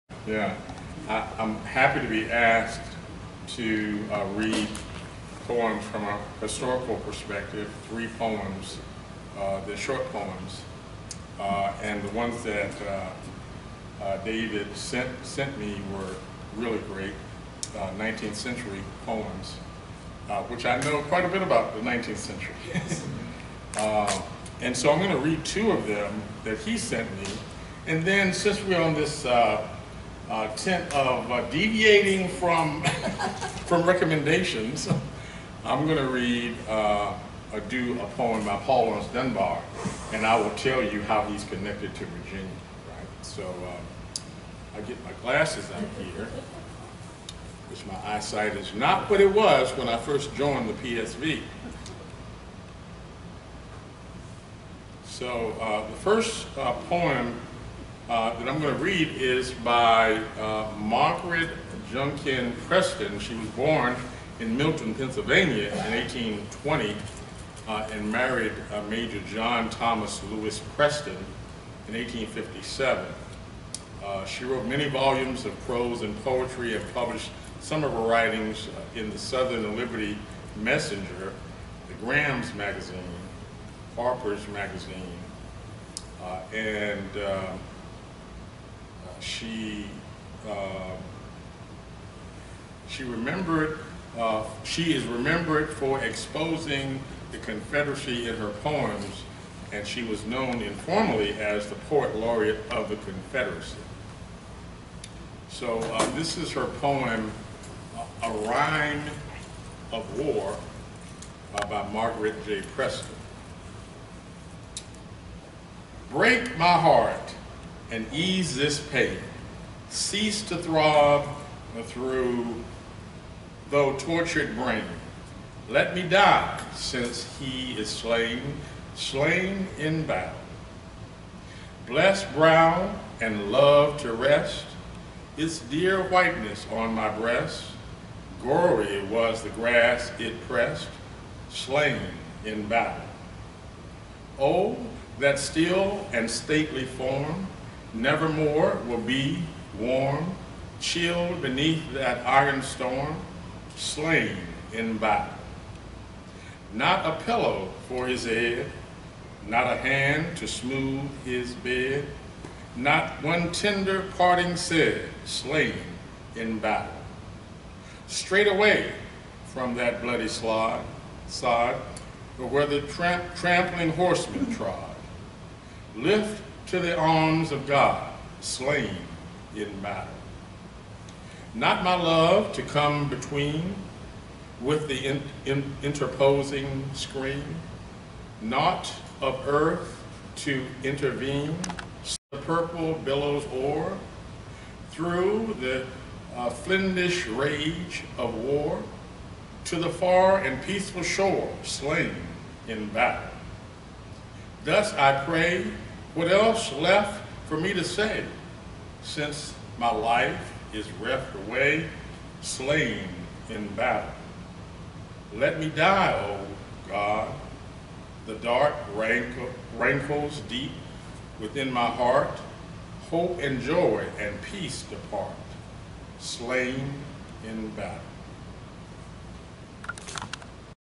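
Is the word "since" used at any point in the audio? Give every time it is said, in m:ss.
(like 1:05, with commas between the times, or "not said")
0:28, 2:06, 3:29.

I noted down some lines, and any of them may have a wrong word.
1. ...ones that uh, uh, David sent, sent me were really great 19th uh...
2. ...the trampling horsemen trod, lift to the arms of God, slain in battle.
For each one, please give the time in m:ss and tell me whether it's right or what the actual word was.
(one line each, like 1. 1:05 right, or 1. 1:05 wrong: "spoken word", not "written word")
1. 0:12 right
2. 2:52 right.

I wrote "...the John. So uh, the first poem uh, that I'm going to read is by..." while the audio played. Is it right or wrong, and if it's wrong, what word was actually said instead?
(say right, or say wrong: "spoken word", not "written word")
wrong: "PSV", not "John".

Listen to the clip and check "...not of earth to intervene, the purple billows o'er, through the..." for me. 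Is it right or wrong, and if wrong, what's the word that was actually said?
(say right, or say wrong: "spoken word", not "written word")
right.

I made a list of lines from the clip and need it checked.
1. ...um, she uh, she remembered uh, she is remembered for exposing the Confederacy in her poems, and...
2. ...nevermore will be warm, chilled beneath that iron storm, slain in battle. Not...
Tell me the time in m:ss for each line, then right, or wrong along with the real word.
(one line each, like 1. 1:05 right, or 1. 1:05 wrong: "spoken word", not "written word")
1. 1:27 right
2. 2:27 right.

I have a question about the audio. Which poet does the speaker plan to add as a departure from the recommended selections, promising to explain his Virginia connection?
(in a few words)
Paul Laurence Dunbar.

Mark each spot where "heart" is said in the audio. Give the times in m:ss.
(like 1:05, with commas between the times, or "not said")
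1:56, 3:41.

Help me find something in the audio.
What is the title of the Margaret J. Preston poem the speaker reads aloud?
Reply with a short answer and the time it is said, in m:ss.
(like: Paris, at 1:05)
A Rhyme of War, at 1:48.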